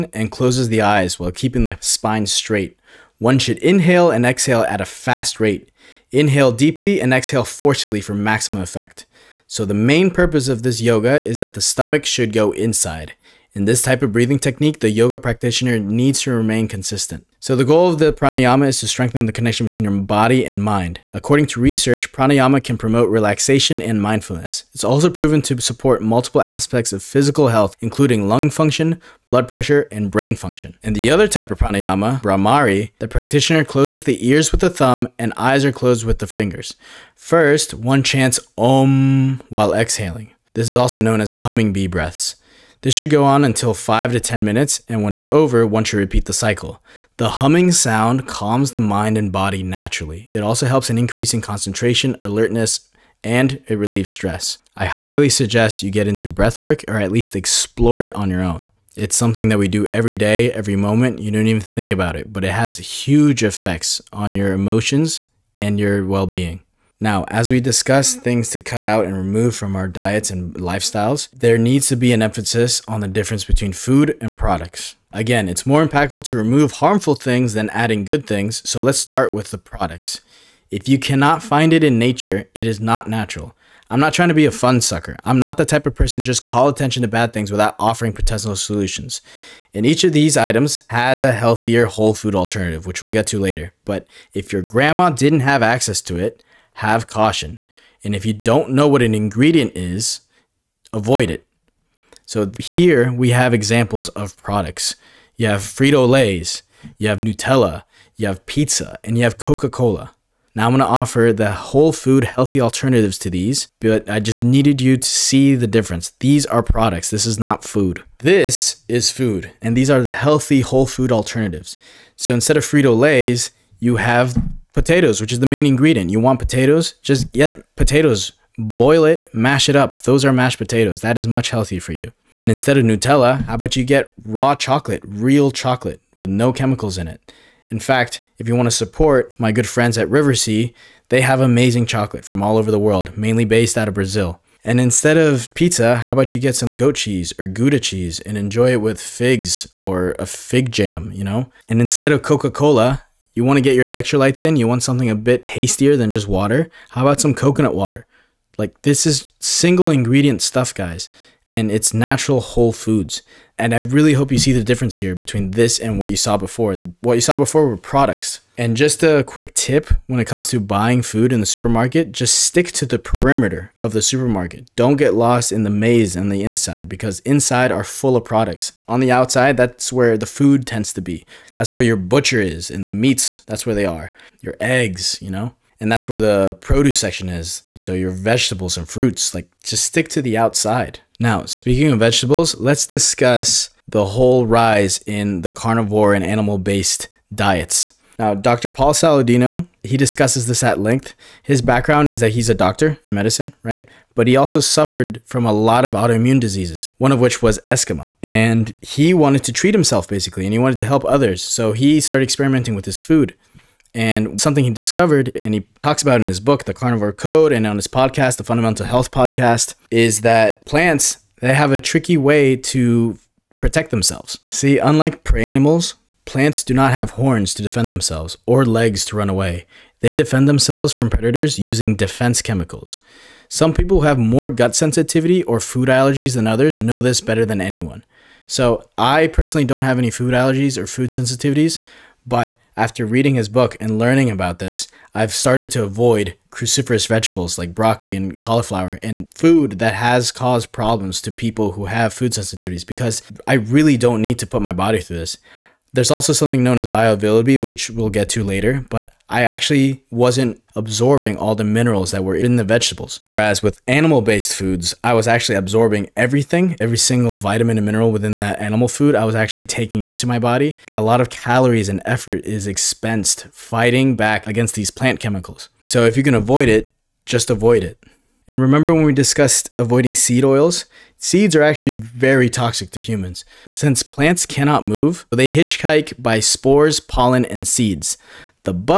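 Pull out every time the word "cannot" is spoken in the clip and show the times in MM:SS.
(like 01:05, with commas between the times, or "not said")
01:20, 04:44.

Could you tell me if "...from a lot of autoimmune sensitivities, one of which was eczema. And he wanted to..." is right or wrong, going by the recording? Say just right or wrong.
wrong.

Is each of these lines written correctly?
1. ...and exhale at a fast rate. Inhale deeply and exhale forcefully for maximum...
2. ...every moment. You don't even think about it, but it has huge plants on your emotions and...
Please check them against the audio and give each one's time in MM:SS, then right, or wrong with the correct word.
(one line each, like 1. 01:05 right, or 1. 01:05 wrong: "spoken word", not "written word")
1. 00:04 right
2. 01:00 wrong: "effects", not "plants".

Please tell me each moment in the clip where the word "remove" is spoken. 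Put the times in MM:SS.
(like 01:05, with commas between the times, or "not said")
01:09, 01:16.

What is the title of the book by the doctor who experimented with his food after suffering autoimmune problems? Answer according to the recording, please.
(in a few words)
The Carnivore Code.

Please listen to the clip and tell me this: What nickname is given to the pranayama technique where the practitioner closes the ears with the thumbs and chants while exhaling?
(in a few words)
humming bee breaths.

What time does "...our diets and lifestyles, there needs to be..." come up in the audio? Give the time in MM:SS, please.
01:09.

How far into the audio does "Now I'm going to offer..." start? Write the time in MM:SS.
01:50.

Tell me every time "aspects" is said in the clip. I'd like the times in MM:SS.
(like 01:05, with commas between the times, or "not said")
00:26.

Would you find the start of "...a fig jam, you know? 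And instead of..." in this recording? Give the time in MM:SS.
02:30.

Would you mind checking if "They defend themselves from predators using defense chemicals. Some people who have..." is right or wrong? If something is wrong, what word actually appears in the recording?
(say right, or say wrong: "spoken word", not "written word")
right.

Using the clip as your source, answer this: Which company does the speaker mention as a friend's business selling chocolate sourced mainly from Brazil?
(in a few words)
Riversea.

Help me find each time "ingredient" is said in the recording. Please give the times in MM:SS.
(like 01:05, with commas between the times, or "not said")
01:39, 02:05, 02:39.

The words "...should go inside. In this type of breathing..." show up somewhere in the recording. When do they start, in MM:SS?
00:12.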